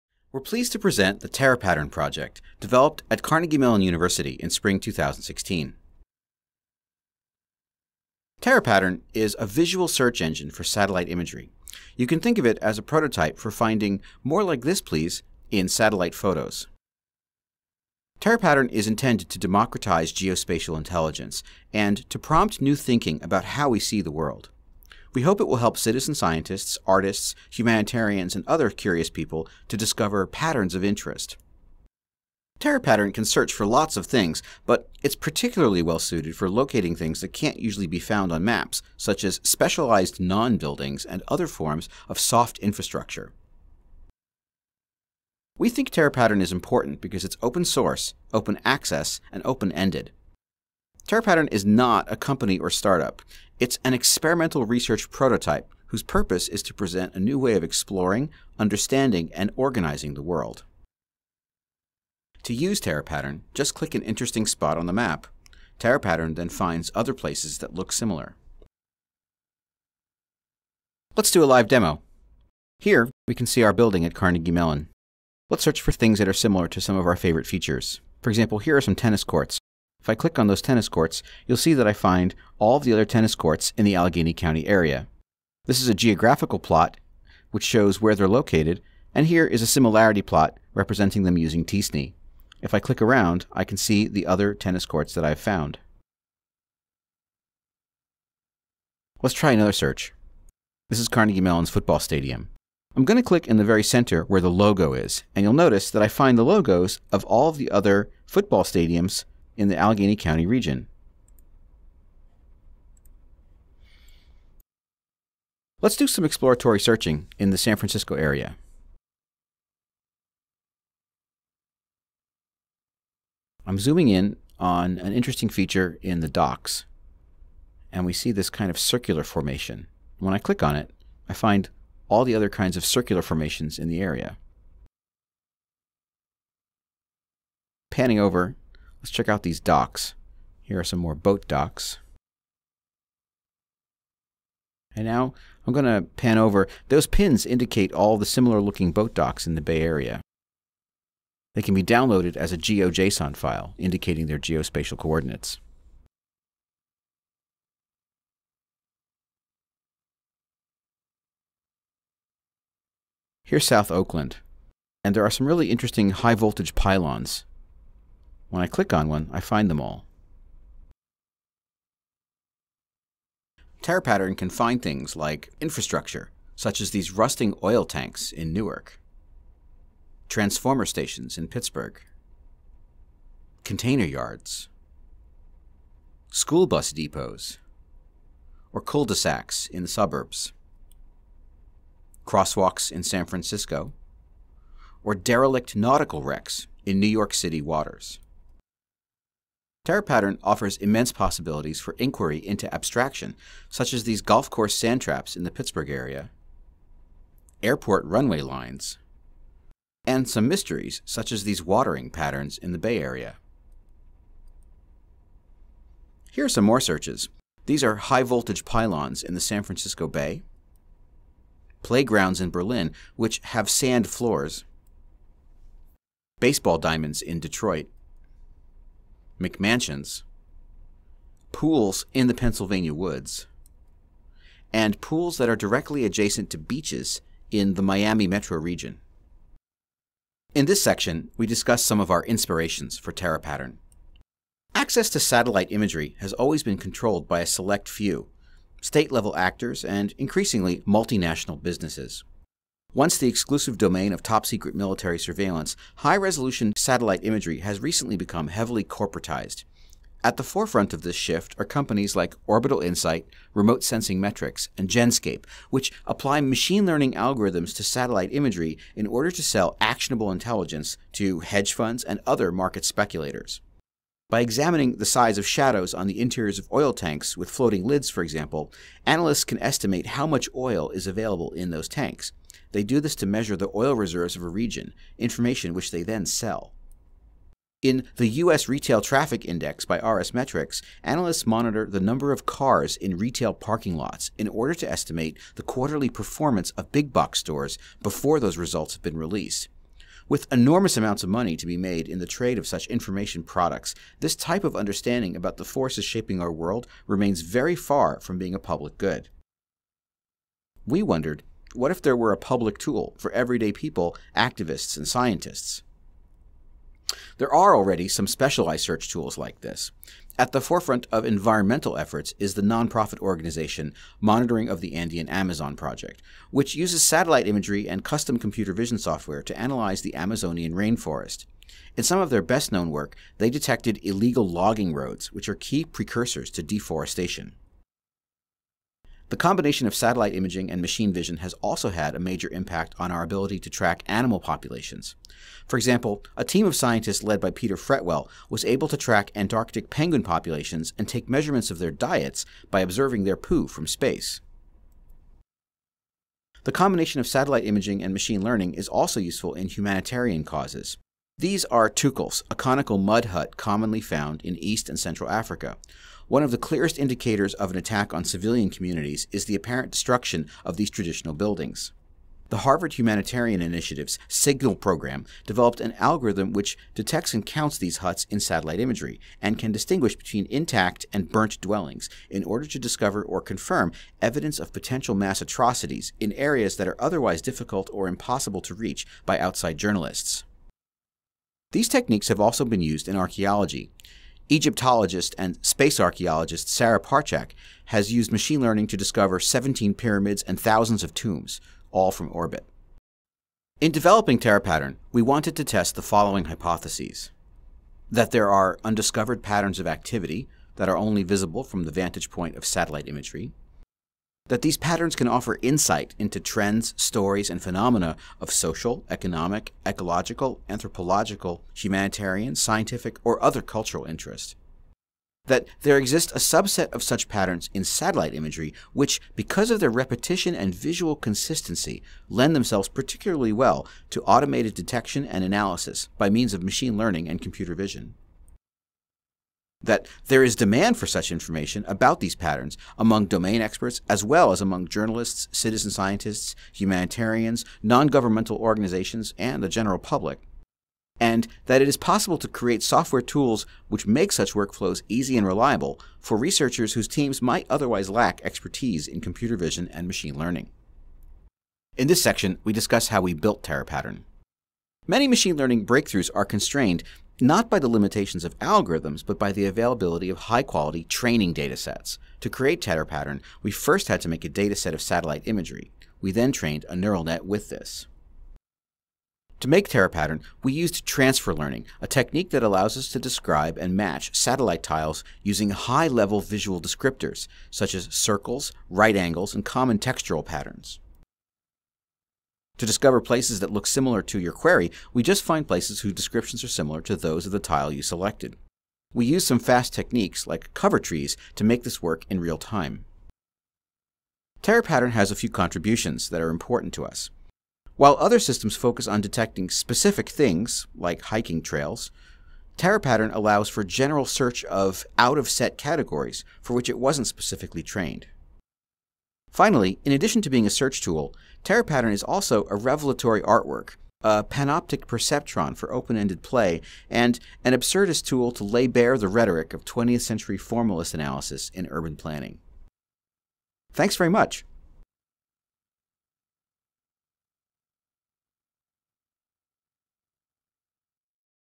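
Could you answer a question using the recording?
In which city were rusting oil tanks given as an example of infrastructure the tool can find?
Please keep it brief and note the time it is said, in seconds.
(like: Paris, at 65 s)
Newark, at 178 s.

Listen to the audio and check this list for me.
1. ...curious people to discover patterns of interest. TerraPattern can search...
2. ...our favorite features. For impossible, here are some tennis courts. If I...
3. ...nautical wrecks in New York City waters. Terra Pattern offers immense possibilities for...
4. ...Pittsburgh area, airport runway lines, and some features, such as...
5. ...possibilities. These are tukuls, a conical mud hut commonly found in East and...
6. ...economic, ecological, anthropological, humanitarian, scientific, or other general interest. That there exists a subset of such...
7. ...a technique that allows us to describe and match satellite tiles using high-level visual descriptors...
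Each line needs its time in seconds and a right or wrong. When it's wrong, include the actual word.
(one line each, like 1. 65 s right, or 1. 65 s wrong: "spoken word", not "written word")
1. 28 s right
2. 77 s wrong: "example", not "impossible"
3. 195 s right
4. 205 s wrong: "mysteries", not "features"
5. 360 s wrong: "causes", not "possibilities"
6. 419 s wrong: "cultural", not "general"
7. 482 s right.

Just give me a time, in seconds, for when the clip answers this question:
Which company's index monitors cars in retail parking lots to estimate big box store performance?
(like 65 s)
289 s.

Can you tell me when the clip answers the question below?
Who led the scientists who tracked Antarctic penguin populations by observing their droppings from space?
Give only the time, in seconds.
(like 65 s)
347 s.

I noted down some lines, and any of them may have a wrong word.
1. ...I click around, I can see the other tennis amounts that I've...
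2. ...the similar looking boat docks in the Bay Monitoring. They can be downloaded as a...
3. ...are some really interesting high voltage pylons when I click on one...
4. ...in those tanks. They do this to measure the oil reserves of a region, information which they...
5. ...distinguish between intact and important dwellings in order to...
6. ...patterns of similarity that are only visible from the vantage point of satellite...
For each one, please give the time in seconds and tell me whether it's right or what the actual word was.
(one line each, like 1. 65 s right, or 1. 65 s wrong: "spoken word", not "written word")
1. 92 s wrong: "courts", not "amounts"
2. 148 s wrong: "Area", not "Monitoring"
3. 165 s right
4. 281 s right
5. 379 s wrong: "burnt", not "important"
6. 409 s wrong: "activity", not "similarity".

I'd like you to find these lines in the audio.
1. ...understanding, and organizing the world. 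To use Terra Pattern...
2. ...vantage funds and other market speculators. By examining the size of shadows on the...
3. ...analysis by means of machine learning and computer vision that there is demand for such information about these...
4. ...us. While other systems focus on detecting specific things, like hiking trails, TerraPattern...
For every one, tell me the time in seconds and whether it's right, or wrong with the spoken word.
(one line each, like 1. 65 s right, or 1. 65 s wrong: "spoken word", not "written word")
1. 58 s right
2. 271 s wrong: "hedge", not "vantage"
3. 435 s right
4. 507 s right.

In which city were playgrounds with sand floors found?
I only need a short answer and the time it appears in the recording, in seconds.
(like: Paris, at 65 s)
Berlin, at 222 s.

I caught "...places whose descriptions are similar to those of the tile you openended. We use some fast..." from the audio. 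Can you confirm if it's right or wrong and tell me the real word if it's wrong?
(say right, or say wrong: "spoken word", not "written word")
wrong: "selected", not "openended".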